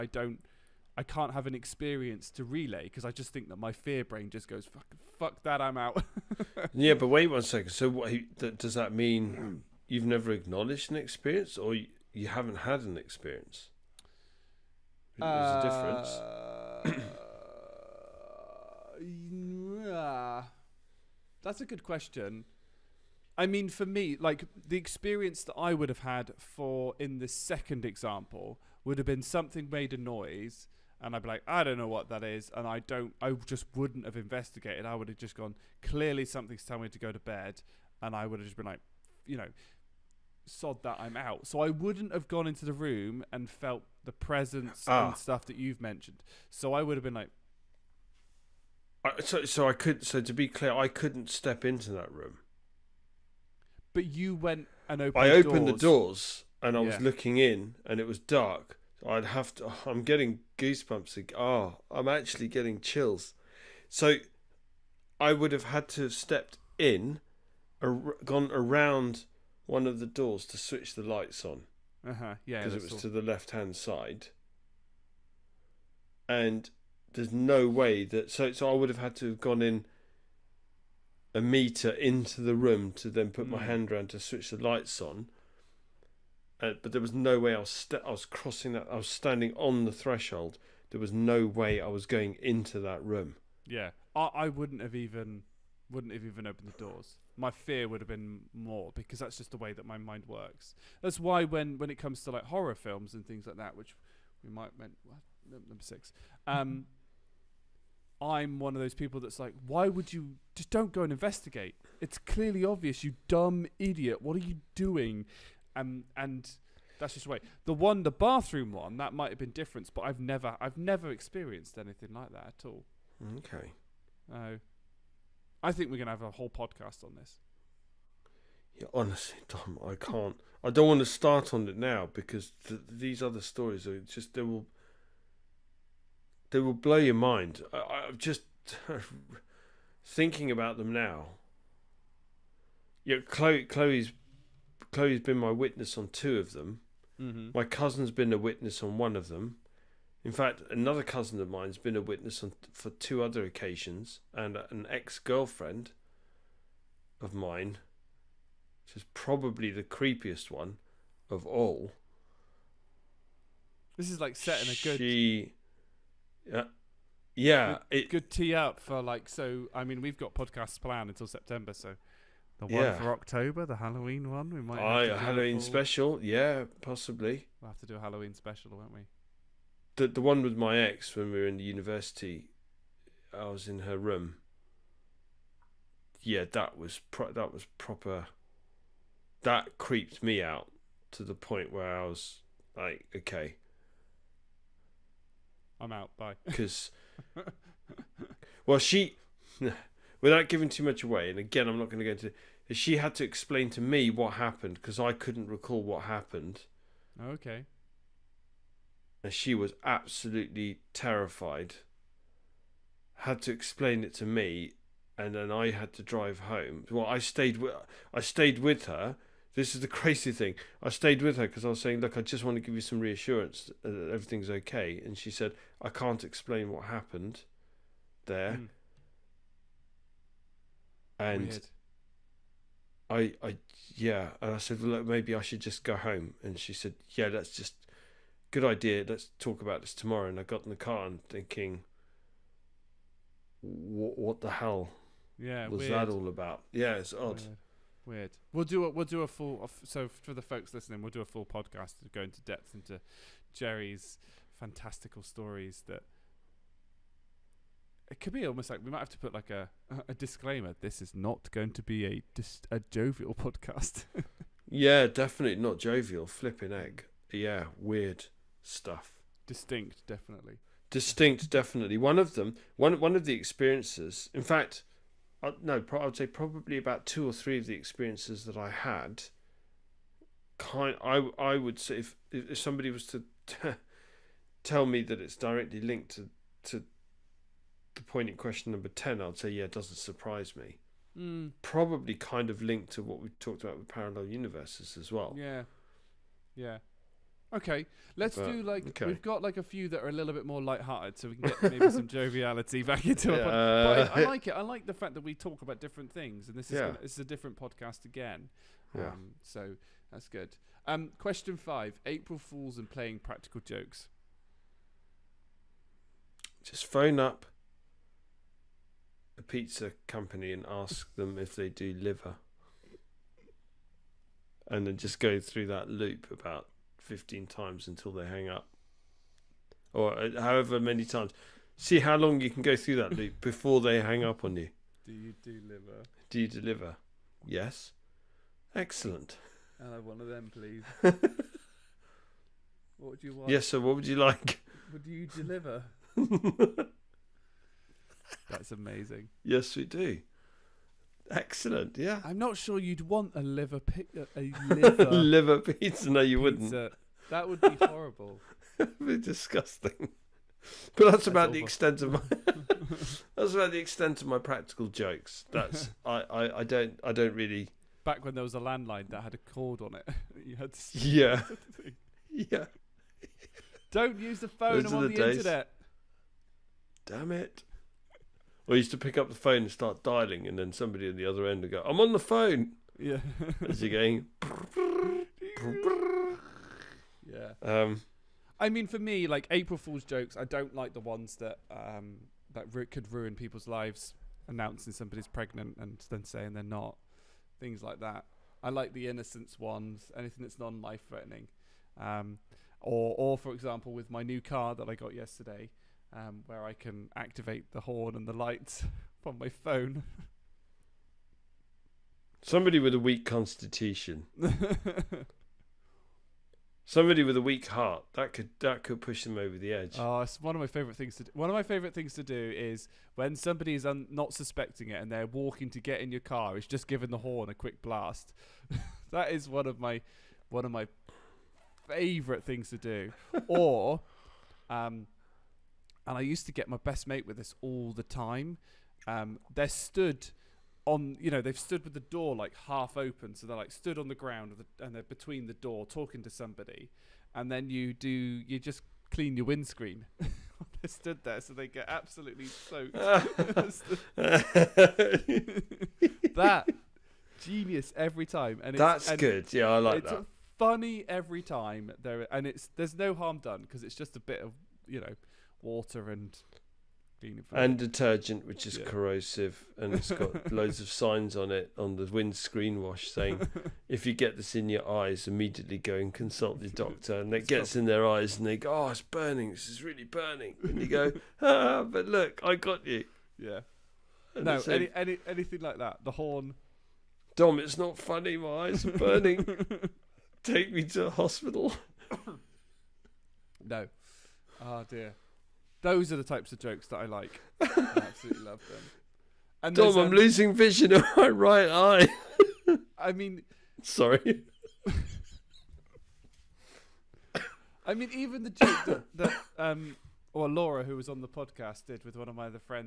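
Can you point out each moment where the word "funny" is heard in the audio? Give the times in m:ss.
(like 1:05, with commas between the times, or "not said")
7:40, 8:07.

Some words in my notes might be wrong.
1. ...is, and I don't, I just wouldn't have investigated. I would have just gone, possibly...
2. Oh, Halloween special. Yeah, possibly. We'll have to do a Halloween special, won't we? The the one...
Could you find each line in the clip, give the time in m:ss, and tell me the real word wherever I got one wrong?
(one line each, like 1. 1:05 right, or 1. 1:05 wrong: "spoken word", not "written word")
1. 0:32 wrong: "clearly", not "possibly"
2. 2:55 right.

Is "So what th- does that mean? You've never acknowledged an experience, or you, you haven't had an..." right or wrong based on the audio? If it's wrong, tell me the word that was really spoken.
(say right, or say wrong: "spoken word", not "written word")
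right.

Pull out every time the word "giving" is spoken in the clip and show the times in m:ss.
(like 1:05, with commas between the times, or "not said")
3:20, 7:06.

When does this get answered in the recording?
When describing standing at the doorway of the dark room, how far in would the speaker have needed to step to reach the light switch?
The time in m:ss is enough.
1:21.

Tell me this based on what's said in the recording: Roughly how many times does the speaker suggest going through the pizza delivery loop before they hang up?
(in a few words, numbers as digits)
15.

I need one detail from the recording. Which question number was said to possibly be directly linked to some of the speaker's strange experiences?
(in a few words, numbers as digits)
10.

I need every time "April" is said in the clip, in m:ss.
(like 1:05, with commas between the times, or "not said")
5:12, 6:29.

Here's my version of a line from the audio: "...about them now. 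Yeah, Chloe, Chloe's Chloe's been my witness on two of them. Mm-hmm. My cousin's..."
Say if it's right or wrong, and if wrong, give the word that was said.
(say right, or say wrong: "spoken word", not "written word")
right.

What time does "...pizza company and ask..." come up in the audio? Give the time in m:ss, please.
5:19.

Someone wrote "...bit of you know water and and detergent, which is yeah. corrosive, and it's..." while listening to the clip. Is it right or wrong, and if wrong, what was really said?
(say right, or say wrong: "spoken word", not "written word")
right.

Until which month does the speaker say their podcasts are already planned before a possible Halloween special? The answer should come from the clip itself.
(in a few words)
September.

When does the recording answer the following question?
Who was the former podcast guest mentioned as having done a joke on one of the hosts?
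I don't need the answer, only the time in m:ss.
8:30.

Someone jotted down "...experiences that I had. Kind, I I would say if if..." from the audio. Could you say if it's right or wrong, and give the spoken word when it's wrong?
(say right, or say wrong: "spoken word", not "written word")
right.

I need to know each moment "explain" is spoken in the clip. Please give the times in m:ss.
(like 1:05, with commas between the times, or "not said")
3:23, 3:33, 3:46.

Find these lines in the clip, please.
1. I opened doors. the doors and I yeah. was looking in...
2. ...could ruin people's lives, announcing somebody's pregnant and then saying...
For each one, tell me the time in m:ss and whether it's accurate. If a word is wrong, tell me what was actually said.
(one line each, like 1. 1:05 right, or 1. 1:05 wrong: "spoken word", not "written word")
1. 0:55 right
2. 6:32 right.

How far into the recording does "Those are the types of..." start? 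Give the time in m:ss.
8:15.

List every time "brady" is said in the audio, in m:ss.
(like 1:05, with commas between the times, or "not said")
not said.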